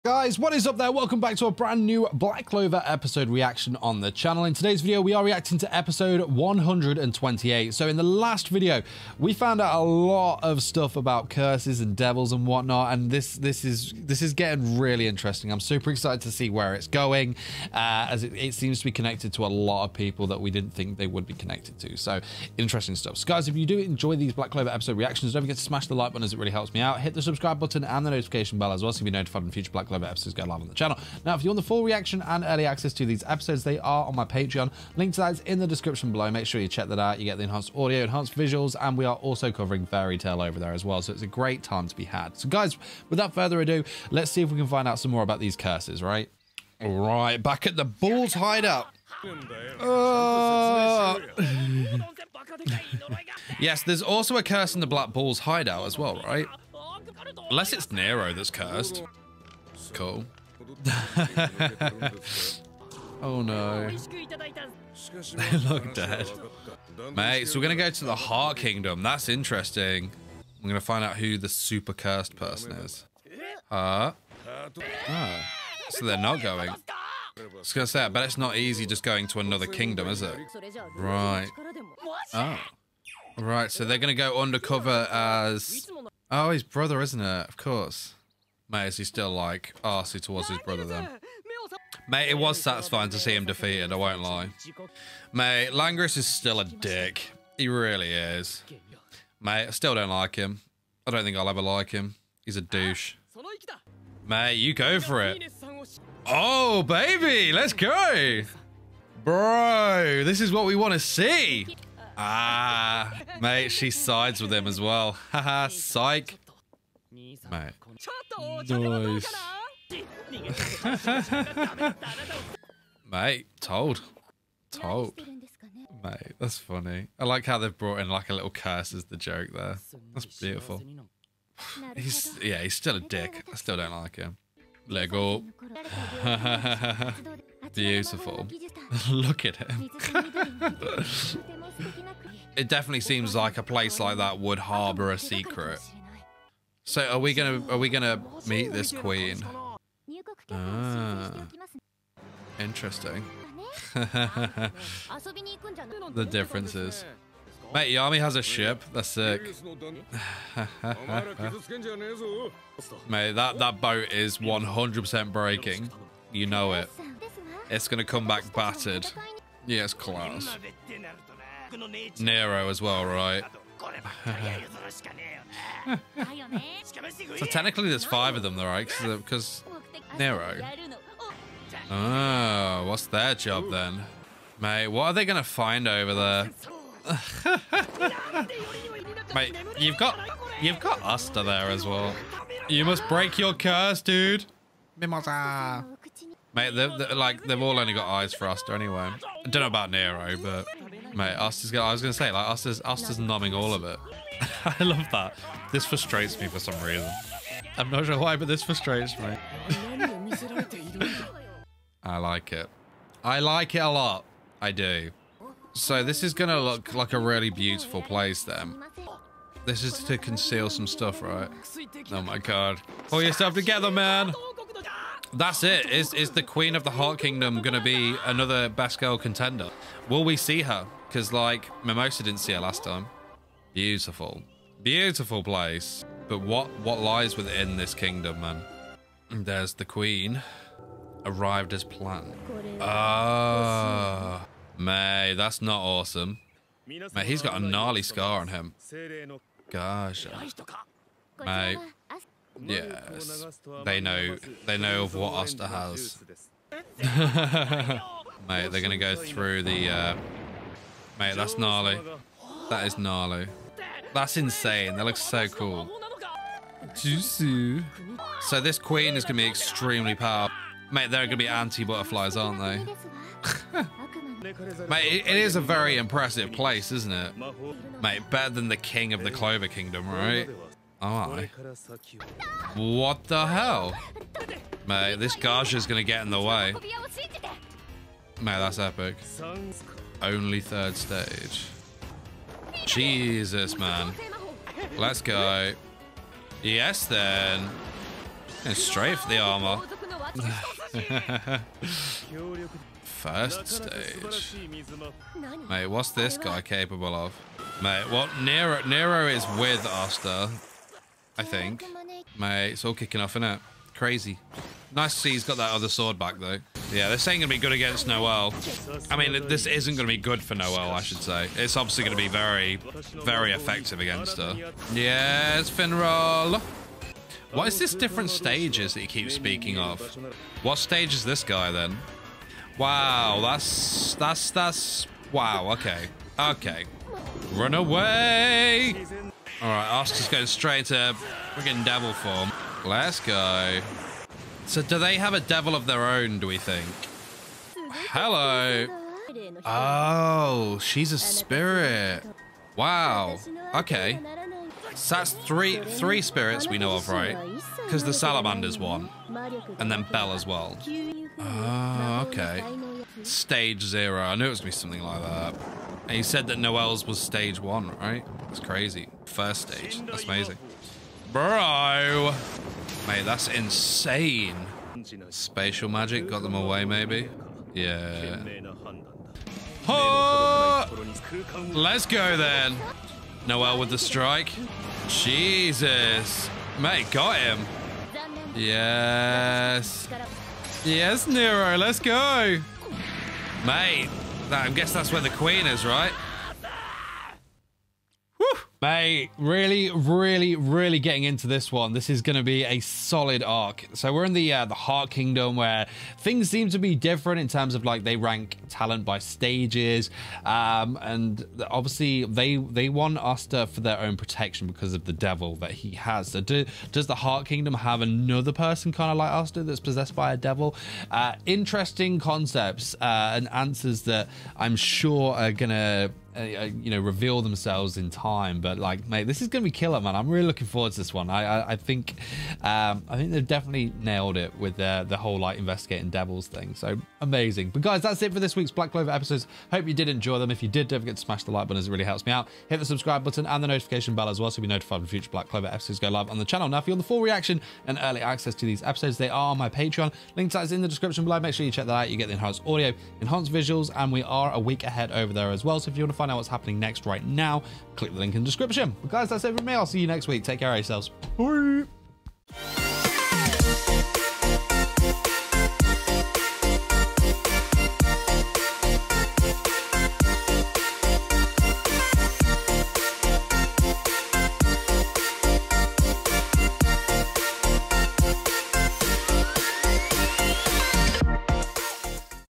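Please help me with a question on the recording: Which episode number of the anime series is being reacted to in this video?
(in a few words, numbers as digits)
128.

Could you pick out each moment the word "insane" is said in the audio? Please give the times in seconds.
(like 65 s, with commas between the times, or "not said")
264 s, 373 s.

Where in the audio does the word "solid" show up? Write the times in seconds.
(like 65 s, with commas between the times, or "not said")
402 s.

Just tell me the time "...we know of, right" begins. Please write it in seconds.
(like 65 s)
356 s.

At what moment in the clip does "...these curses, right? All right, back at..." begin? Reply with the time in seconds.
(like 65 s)
45 s.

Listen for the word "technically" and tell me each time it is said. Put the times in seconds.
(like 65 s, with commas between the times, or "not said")
177 s.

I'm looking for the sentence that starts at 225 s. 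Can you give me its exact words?
Is is the Queen of the Heart Kingdom going to be another best girl contender?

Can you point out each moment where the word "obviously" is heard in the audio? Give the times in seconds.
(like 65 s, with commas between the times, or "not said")
321 s, 411 s.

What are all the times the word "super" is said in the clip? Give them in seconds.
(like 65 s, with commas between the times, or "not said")
15 s, 71 s.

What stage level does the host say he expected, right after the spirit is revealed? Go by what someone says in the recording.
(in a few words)
stage zero.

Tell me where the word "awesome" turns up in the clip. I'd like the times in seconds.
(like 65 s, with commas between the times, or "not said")
245 s.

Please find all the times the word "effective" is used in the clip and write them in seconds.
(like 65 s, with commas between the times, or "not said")
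323 s.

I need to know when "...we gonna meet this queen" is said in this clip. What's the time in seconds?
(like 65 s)
147 s.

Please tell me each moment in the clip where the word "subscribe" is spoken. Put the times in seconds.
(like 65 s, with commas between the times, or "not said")
27 s, 442 s.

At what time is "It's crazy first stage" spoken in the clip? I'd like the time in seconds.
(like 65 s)
368 s.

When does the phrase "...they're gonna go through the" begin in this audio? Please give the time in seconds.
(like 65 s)
258 s.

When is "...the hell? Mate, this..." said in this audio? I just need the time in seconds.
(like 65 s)
283 s.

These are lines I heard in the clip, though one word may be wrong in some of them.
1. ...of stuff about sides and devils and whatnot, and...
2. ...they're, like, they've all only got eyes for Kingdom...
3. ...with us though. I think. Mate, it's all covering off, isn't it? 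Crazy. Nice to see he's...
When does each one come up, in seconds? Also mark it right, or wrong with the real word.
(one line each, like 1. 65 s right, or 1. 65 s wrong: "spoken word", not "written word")
1. 10 s wrong: "curses", not "sides"
2. 196 s wrong: "Asta", not "Kingdom"
3. 309 s wrong: "kicking", not "covering".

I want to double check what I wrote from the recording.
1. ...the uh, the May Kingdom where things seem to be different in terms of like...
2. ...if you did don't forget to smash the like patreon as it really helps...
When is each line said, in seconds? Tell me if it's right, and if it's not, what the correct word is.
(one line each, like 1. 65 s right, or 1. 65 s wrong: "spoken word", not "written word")
1. 404 s wrong: "Heart", not "May"
2. 440 s wrong: "button", not "patreon".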